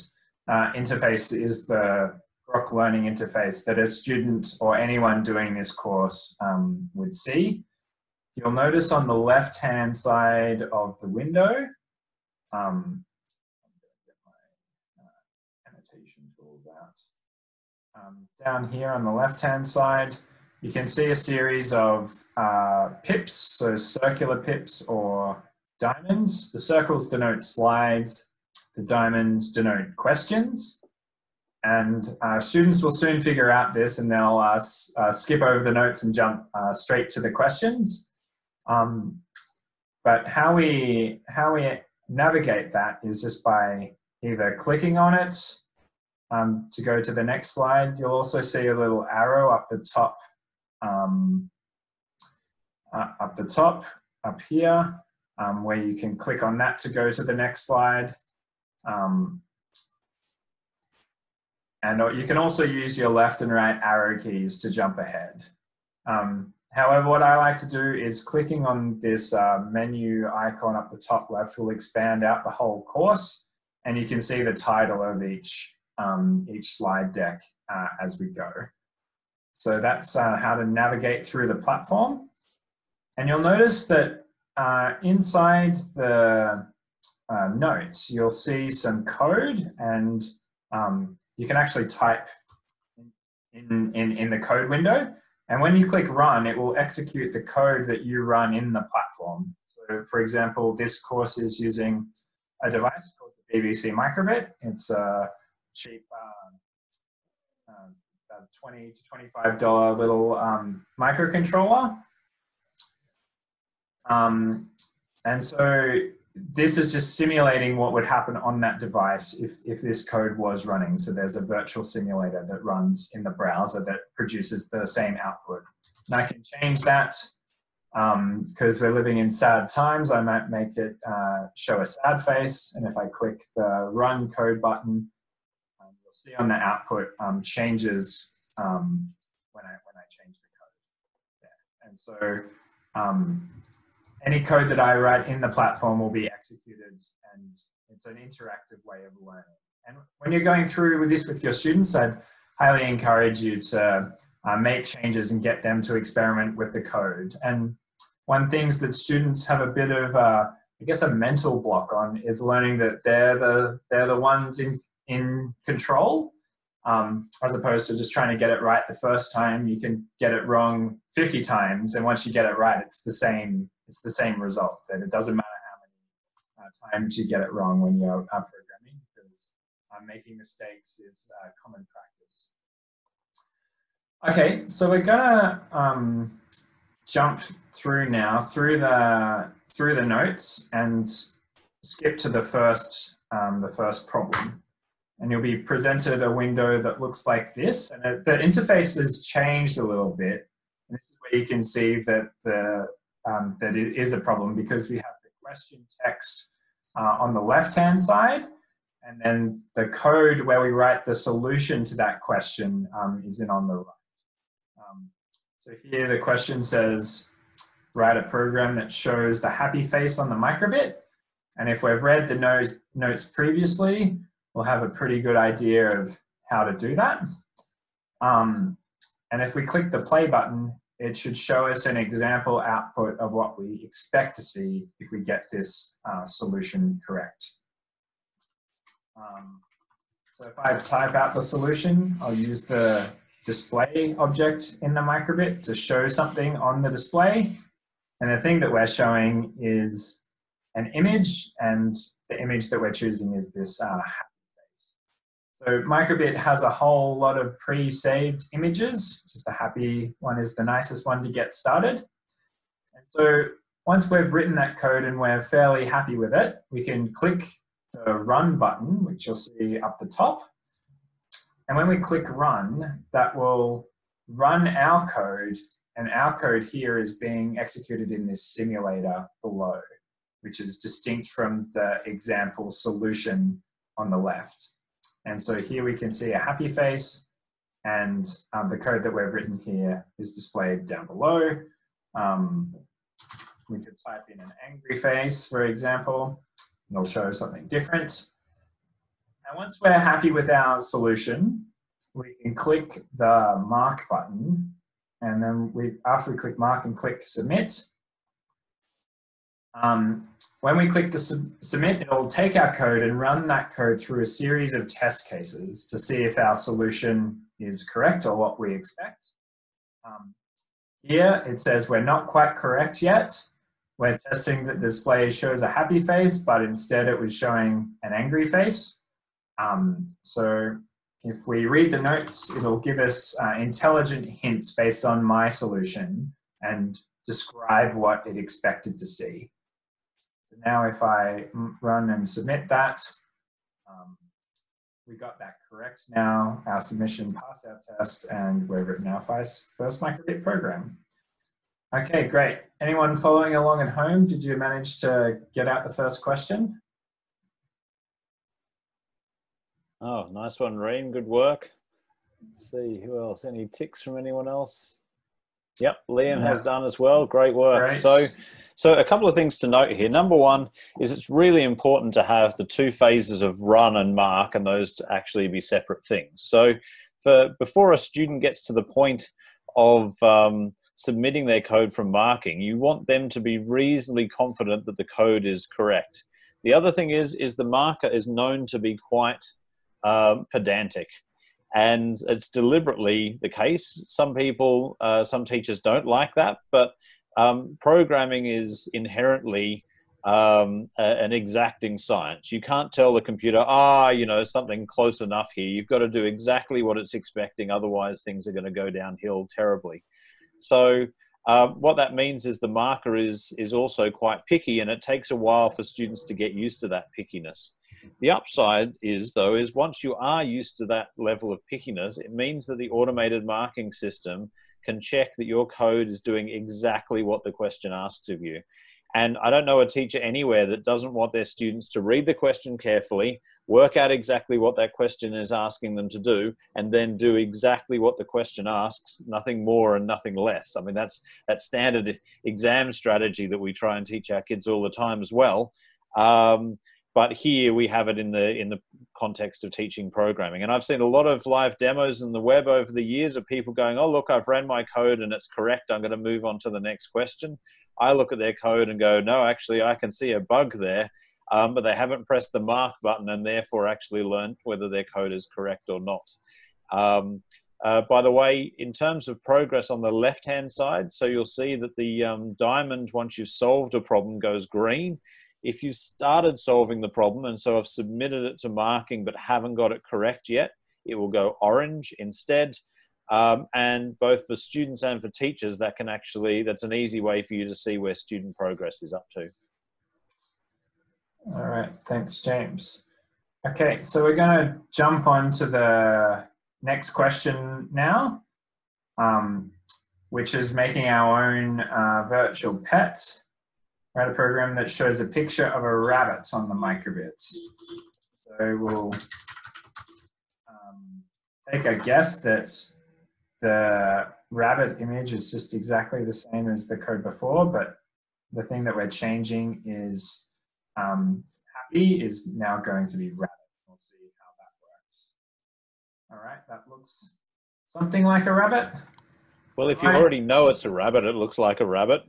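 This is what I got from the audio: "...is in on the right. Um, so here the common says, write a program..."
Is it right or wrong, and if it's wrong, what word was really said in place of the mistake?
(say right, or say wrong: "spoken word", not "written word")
wrong: "question", not "common".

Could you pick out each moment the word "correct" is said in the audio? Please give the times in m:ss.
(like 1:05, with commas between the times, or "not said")
3:57, 5:17, 5:22, 5:45, 6:25, 7:35, 7:45, 8:00.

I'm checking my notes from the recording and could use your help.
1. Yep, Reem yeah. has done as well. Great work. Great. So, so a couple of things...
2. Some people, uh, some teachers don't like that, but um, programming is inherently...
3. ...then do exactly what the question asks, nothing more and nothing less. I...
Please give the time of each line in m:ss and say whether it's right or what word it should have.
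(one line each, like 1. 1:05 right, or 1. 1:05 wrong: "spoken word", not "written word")
1. 6:05 wrong: "Liam", not "Reem"
2. 6:34 right
3. 7:16 right.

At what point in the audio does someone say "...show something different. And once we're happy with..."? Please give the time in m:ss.
4:57.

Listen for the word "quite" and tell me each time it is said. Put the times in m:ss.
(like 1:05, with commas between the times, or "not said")
5:22, 6:28, 6:54.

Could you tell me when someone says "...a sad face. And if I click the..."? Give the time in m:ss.
2:11.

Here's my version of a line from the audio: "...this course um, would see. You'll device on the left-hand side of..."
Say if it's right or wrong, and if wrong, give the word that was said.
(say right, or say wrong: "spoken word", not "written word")
wrong: "notice", not "device".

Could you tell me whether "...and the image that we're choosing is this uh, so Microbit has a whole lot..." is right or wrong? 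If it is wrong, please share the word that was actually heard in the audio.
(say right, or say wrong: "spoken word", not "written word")
right.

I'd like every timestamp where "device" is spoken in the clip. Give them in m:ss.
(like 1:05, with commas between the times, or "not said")
1:42, 1:58.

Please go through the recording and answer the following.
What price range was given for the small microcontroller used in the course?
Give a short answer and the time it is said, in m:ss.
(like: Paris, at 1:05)
$20 to $25, at 1:48.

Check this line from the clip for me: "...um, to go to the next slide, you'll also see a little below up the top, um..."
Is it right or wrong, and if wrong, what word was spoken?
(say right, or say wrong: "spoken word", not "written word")
wrong: "arrow", not "below".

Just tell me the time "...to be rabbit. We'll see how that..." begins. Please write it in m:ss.
8:43.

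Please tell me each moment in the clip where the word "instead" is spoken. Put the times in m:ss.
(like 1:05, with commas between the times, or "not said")
5:26, 8:02.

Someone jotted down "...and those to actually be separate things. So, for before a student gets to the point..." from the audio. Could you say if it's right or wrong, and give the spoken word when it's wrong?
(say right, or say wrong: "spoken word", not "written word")
right.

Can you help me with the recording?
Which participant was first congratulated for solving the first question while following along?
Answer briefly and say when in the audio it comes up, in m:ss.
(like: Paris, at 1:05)
Reem, at 6:00.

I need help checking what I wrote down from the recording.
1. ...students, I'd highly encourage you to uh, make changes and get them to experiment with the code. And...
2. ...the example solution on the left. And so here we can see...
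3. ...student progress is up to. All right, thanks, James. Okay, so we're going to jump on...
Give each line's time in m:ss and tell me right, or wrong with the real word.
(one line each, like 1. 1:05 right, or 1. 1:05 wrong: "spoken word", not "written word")
1. 2:31 right
2. 4:41 right
3. 8:08 right.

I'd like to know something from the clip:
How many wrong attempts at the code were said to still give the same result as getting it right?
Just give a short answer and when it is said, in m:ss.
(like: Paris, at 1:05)
50, at 2:51.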